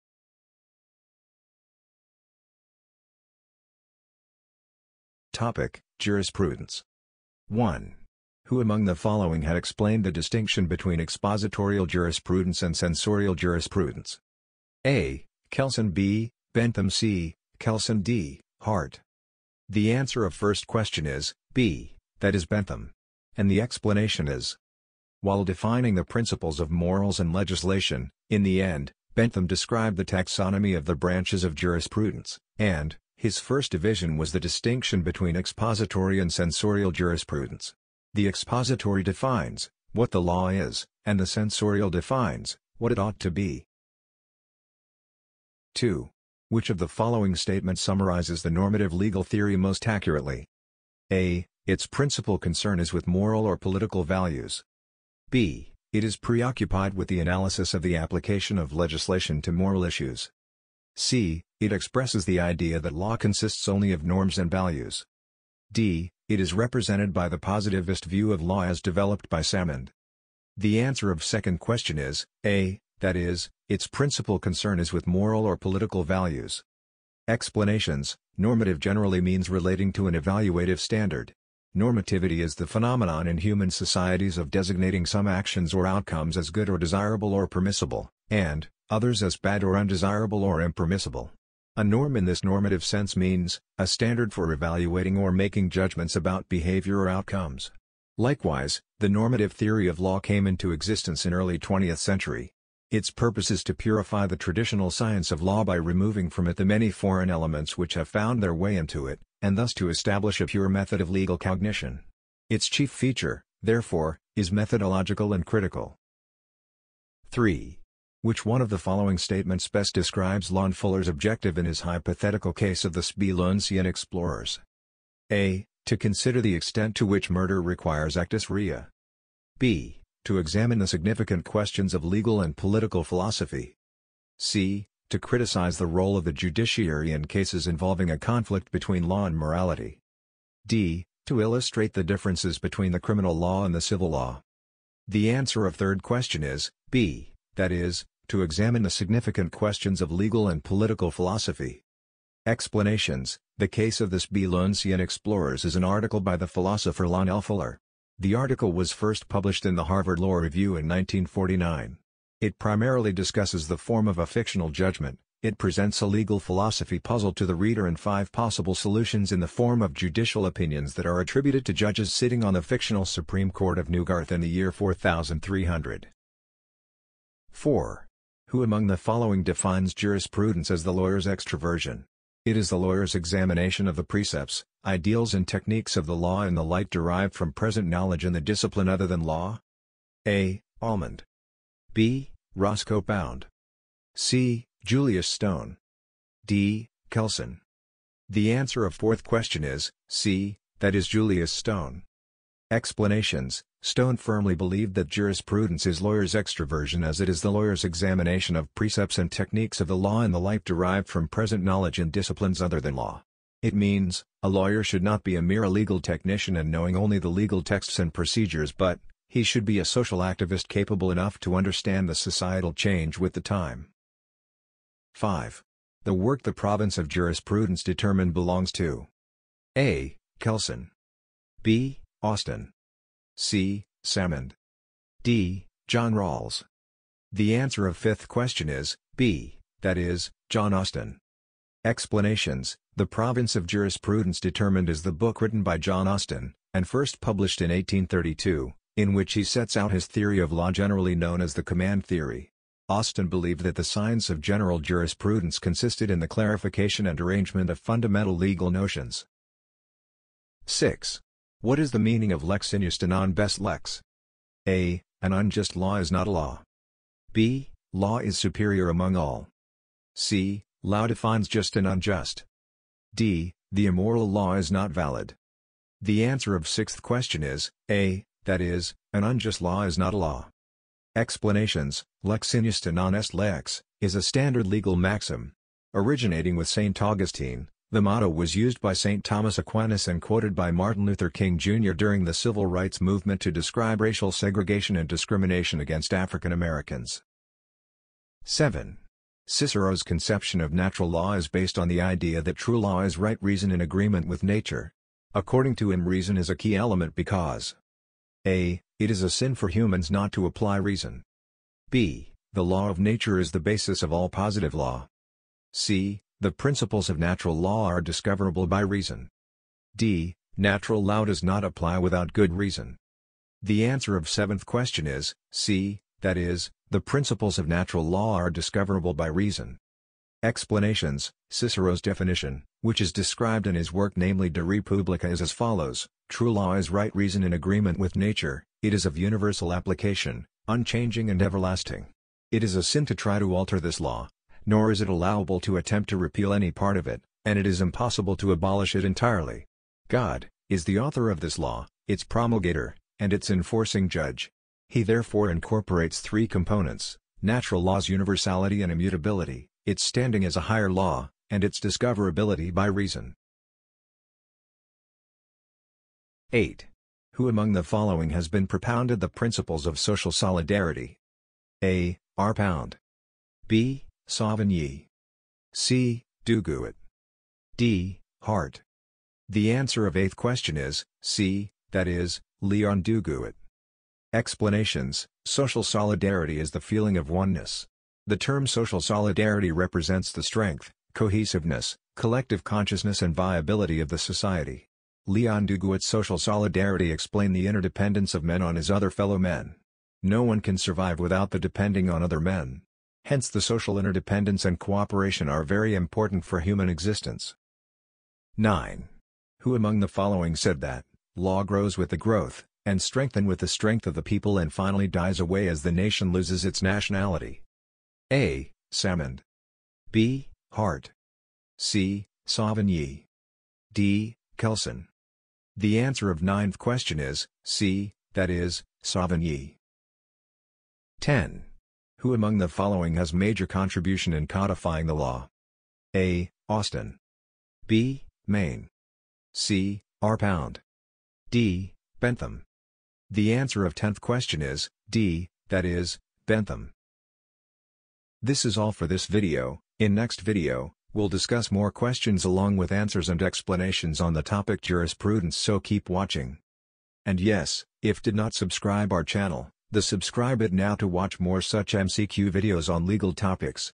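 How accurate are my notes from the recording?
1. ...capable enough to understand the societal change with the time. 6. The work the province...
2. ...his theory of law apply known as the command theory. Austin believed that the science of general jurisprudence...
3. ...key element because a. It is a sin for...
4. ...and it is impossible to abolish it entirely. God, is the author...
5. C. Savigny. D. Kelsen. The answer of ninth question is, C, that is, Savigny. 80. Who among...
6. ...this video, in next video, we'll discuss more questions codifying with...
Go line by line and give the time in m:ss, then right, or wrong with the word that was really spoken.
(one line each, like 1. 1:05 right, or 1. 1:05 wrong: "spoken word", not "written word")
1. 3:40 wrong: "5", not "6"
2. 4:09 wrong: "generally", not "apply"
3. 5:06 right
4. 5:47 right
5. 7:01 wrong: "10", not "80"
6. 7:29 wrong: "along", not "codifying".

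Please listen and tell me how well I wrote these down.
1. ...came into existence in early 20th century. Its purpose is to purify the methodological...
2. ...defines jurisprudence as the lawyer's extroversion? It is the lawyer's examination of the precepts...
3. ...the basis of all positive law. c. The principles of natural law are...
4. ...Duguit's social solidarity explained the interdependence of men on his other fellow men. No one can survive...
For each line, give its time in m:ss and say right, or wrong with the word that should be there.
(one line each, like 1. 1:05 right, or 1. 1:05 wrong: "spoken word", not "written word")
1. 1:40 wrong: "traditional", not "methodological"
2. 2:59 right
3. 5:13 right
4. 6:35 right.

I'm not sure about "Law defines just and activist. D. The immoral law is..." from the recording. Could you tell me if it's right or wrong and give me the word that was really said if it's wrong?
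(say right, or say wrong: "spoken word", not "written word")
wrong: "unjust", not "activist".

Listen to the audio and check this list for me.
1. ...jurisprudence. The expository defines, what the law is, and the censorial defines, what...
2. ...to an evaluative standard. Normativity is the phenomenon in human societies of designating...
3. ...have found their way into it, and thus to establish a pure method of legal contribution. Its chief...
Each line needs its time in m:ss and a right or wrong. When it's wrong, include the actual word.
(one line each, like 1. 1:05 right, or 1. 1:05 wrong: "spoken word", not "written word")
1. 0:36 right
2. 1:19 right
3. 1:47 wrong: "cognition", not "contribution".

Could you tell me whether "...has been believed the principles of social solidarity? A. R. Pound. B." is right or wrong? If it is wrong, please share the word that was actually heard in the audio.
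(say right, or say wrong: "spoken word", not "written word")
wrong: "propounded", not "believed".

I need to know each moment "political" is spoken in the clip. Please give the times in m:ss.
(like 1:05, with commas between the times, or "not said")
0:53, 1:15, 2:12, 2:30.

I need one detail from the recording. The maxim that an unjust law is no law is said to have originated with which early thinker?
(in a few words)
St. Augustine.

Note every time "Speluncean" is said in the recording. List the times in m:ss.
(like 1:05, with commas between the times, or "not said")
2:03, 2:34.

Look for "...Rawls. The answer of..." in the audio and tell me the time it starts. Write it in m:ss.
3:56.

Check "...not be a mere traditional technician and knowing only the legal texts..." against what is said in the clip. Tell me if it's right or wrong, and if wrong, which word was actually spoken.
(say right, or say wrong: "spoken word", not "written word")
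wrong: "legal", not "traditional".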